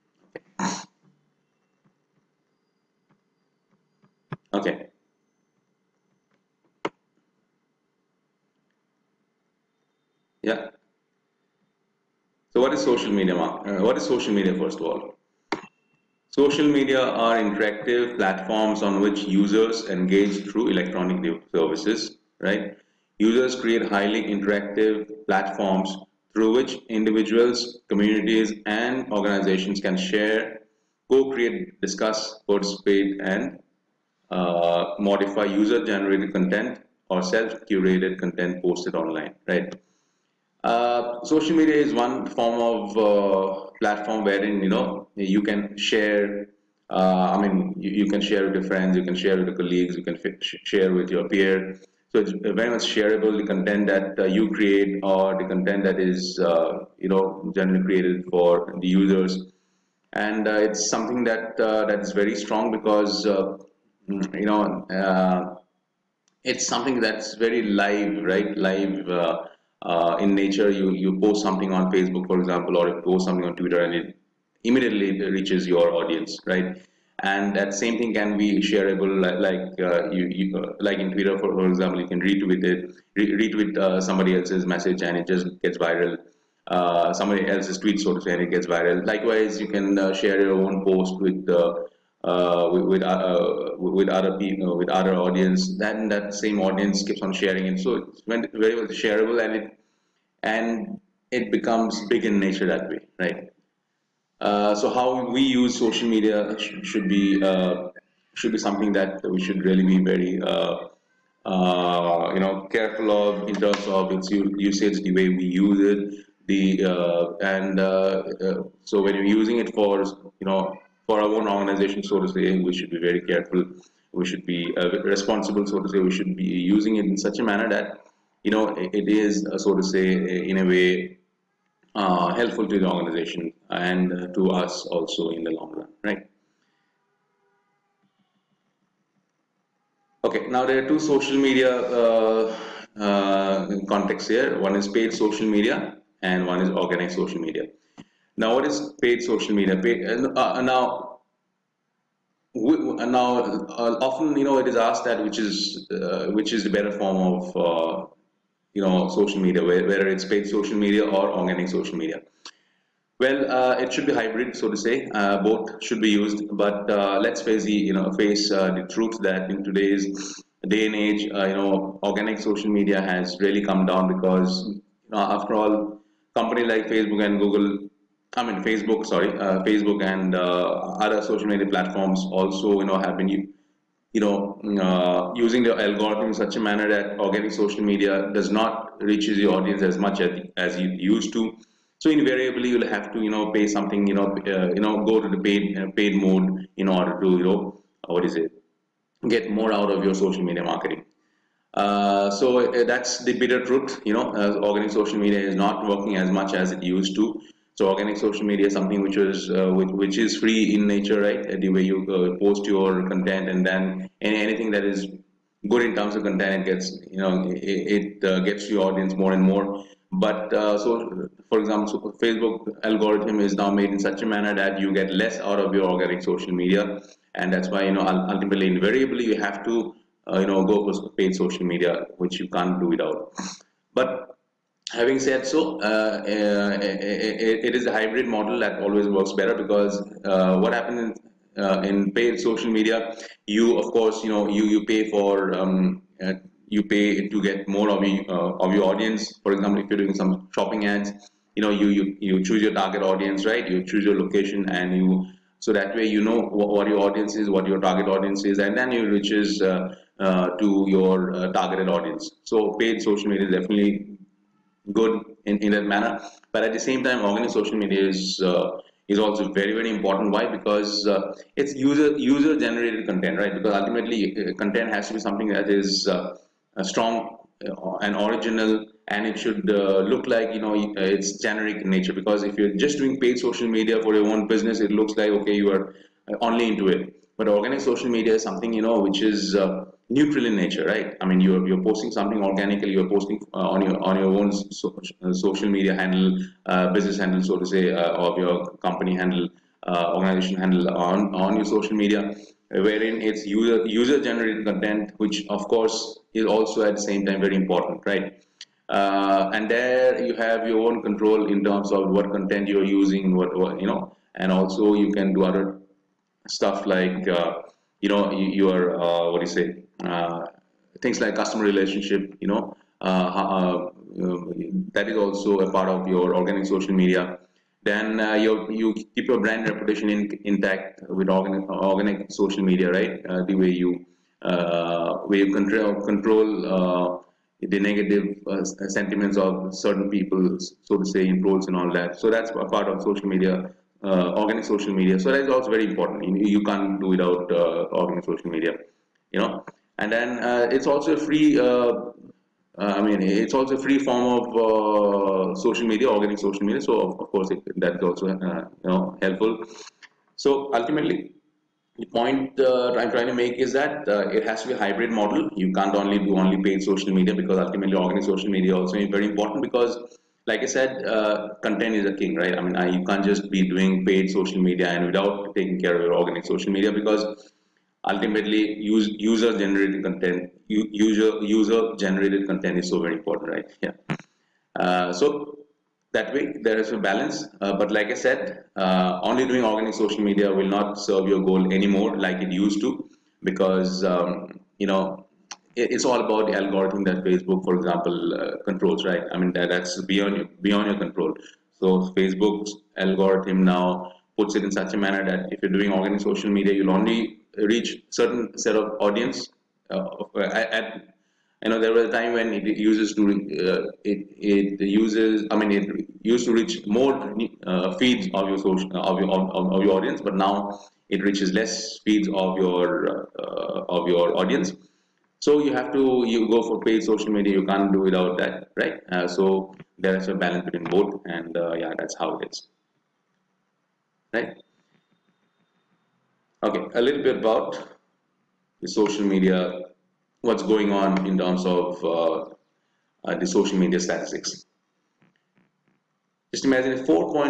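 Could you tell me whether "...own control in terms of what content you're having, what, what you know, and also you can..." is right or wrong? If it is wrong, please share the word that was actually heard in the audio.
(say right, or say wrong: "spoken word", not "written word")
wrong: "using", not "having".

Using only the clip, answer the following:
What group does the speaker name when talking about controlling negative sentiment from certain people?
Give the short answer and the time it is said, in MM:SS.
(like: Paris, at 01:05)
trolls, at 05:41.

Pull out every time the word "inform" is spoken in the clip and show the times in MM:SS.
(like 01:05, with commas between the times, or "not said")
not said.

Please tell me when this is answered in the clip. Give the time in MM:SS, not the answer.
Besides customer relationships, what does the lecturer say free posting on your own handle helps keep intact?
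05:29.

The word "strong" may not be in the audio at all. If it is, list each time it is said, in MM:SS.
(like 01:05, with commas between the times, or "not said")
01:02, 04:36.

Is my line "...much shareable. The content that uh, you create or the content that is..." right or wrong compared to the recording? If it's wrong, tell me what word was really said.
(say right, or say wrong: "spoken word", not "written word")
right.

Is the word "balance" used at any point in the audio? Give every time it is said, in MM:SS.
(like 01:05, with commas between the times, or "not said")
06:26, 07:10.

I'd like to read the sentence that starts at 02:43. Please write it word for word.
Well, uh, it should be hybrid, so to say.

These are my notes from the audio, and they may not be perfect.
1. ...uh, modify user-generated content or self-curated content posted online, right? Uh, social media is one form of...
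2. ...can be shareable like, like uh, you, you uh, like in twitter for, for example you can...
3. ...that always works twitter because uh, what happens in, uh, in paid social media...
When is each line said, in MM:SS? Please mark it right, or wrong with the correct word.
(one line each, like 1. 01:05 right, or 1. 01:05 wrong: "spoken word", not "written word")
1. 00:34 right
2. 01:18 right
3. 03:58 wrong: "better", not "twitter".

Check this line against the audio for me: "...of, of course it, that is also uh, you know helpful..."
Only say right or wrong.
right.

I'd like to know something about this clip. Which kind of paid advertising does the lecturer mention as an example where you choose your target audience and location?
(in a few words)
shopping ads.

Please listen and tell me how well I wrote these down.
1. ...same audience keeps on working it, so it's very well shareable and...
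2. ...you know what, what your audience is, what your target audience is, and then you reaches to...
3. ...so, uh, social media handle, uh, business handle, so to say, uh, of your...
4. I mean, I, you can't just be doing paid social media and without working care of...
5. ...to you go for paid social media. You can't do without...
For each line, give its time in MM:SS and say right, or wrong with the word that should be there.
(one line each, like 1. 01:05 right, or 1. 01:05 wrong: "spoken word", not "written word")
1. 01:36 wrong: "sharing", not "working"
2. 04:16 right
3. 04:54 right
4. 06:12 wrong: "taking", not "working"
5. 07:05 right.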